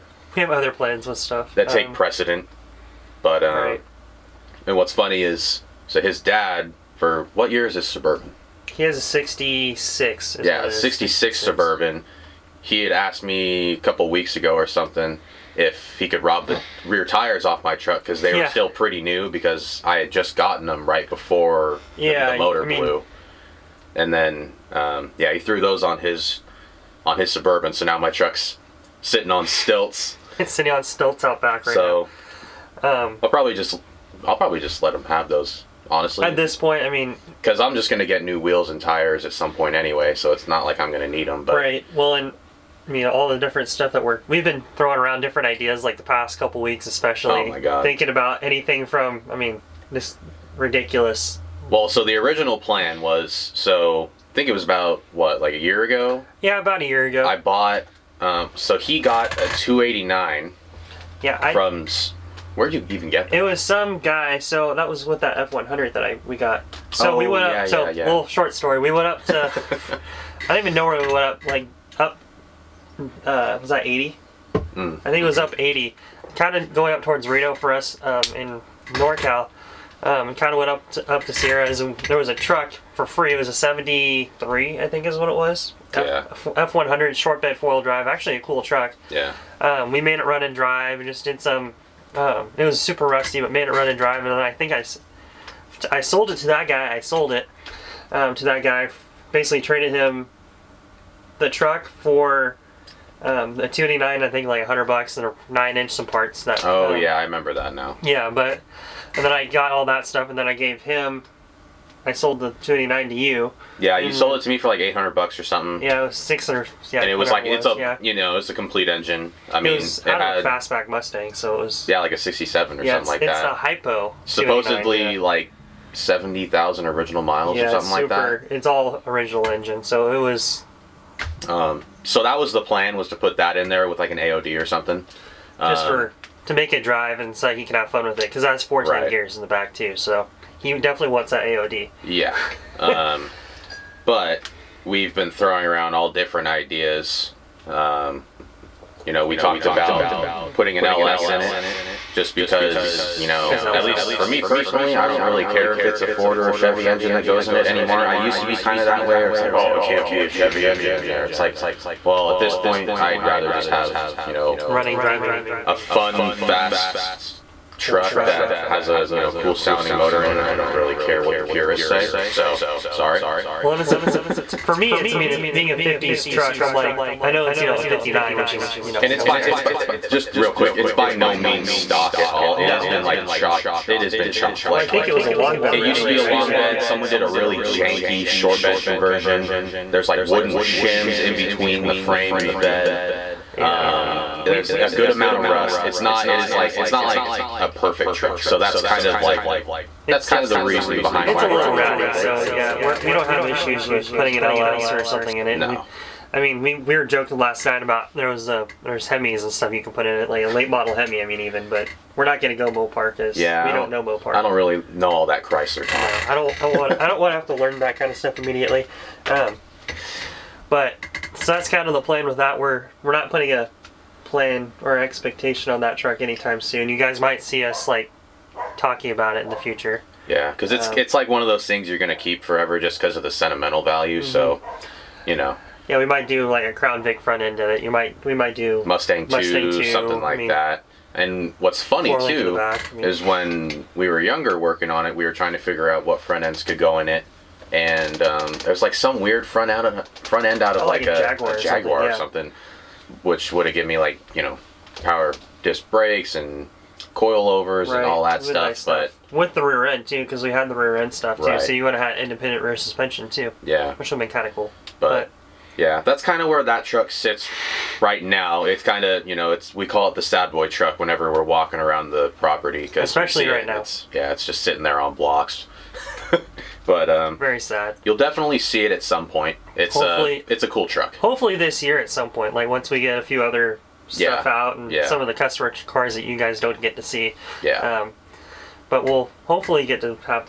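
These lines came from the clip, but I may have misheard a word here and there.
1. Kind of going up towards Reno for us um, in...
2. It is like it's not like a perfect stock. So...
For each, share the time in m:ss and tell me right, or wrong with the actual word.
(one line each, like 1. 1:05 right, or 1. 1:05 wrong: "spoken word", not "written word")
1. 1:16 right
2. 3:16 wrong: "truck", not "stock".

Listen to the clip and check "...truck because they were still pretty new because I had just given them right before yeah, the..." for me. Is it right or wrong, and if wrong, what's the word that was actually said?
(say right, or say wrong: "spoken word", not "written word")
wrong: "gotten", not "given".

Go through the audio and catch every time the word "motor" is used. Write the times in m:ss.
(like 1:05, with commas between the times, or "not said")
0:22, 2:49.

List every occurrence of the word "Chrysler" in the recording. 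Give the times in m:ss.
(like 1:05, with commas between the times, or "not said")
3:35.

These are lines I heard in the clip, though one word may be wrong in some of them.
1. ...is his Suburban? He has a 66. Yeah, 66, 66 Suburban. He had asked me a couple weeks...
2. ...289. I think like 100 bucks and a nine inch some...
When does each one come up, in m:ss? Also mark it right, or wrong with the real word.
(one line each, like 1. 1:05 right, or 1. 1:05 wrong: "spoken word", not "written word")
1. 0:07 right
2. 1:43 right.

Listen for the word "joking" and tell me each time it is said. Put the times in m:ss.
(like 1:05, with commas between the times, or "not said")
3:27.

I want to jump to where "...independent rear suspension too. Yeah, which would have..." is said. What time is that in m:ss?
4:22.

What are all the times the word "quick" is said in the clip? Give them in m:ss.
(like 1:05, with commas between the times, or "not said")
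3:00.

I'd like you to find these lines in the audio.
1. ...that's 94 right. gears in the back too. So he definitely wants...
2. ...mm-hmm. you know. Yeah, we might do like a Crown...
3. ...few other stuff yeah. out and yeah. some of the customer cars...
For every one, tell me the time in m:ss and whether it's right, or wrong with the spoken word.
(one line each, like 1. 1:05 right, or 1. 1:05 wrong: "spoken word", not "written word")
1. 2:18 wrong: "14", not "94"
2. 3:54 right
3. 4:43 right.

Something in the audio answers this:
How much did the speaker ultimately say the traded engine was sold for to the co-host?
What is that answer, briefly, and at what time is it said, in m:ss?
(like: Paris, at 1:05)
$600, at 1:56.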